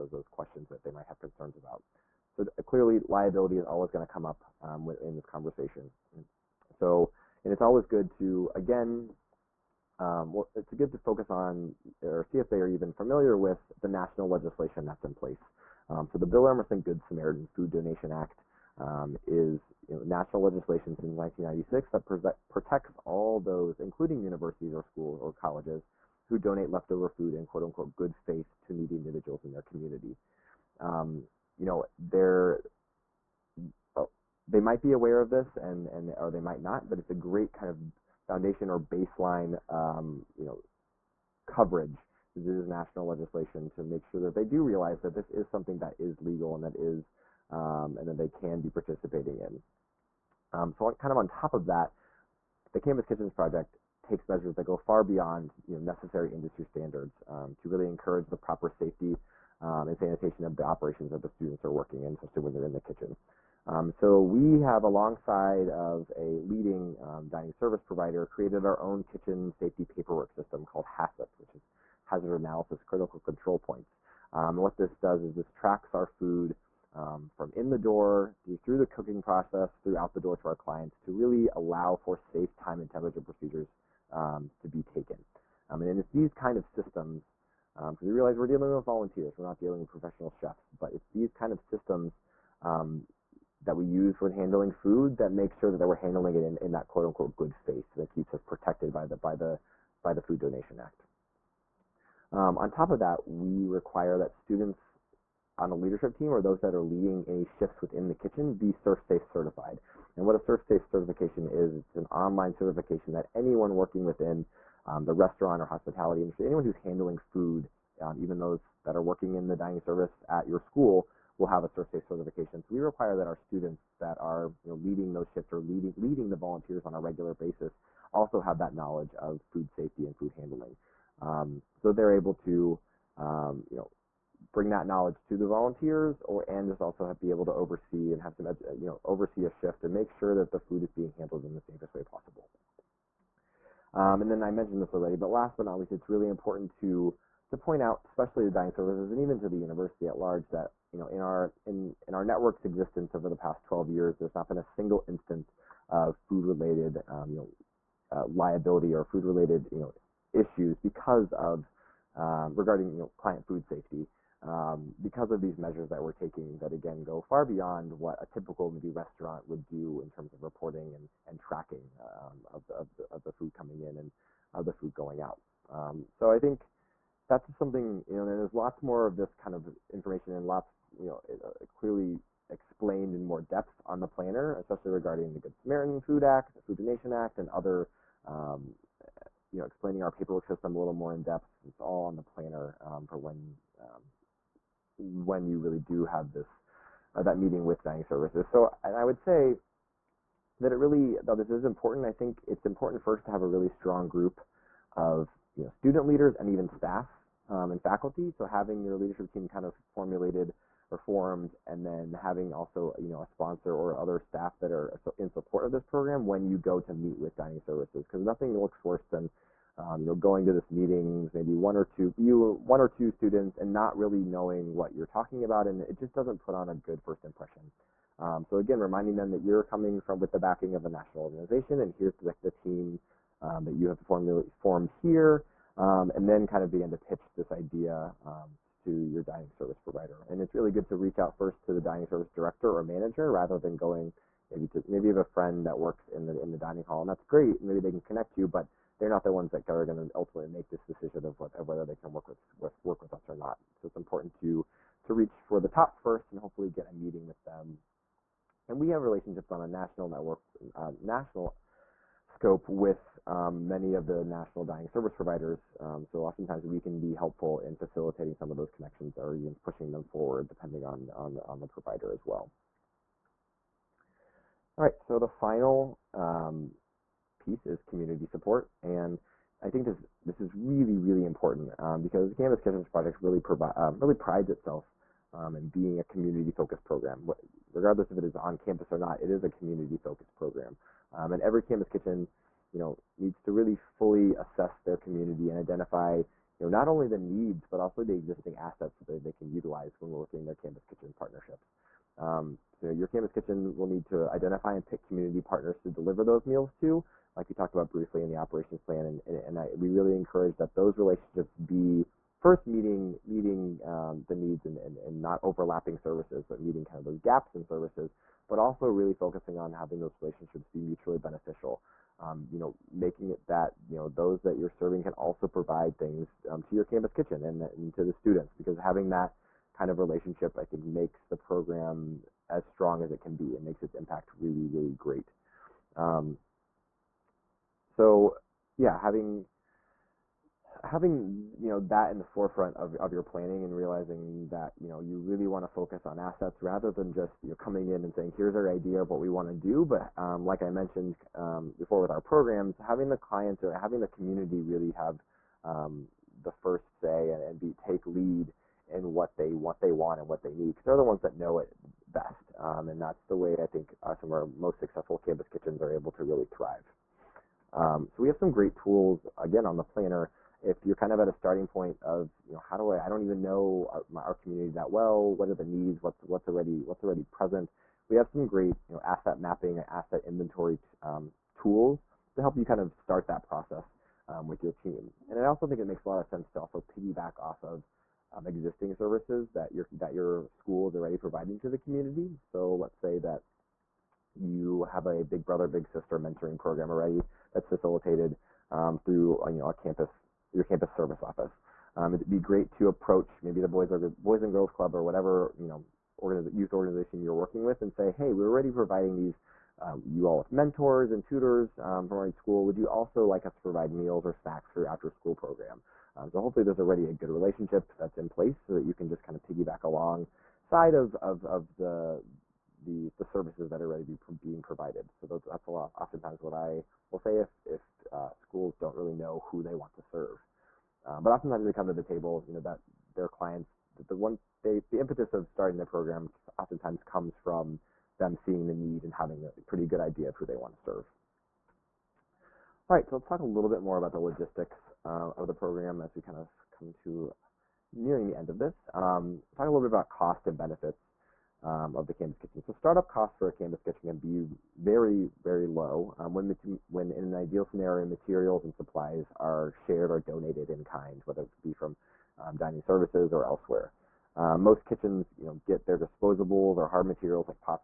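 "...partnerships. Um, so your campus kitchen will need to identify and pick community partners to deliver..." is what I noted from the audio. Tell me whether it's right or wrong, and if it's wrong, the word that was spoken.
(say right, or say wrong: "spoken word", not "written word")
right.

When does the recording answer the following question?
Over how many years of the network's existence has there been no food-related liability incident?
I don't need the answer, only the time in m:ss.
2:33.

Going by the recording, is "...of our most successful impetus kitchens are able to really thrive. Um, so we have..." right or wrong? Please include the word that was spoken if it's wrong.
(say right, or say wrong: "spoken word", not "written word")
wrong: "campus", not "impetus".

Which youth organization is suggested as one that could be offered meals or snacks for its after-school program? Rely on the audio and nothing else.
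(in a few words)
Boys and Girls Club.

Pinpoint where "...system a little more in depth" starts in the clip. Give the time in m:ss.
3:10.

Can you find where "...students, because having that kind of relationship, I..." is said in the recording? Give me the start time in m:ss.
5:28.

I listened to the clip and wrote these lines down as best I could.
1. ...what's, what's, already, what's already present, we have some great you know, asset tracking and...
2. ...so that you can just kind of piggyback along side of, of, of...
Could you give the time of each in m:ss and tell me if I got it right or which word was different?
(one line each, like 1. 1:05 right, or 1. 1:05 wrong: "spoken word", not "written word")
1. 6:16 wrong: "mapping", not "tracking"
2. 6:58 right.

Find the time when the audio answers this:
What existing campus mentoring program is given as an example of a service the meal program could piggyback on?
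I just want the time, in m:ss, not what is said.
6:35.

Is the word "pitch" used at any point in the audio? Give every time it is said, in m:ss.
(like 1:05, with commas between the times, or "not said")
3:56.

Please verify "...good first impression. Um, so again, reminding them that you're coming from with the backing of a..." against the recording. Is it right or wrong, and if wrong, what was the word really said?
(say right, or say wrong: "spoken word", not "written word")
right.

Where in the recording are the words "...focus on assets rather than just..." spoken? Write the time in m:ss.
5:45.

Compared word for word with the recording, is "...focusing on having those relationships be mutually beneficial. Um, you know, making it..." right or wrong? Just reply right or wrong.
right.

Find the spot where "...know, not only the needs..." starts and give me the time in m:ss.
4:56.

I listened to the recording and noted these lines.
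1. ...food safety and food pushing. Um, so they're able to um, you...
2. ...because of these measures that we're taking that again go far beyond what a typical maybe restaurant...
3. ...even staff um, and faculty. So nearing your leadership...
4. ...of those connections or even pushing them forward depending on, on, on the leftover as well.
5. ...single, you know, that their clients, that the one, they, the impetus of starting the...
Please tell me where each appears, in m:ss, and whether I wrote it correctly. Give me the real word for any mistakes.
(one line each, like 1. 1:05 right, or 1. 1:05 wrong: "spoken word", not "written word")
1. 2:09 wrong: "handling", not "pushing"
2. 2:44 right
3. 3:26 wrong: "having", not "nearing"
4. 4:28 wrong: "provider", not "leftover"
5. 7:12 wrong: "table", not "single".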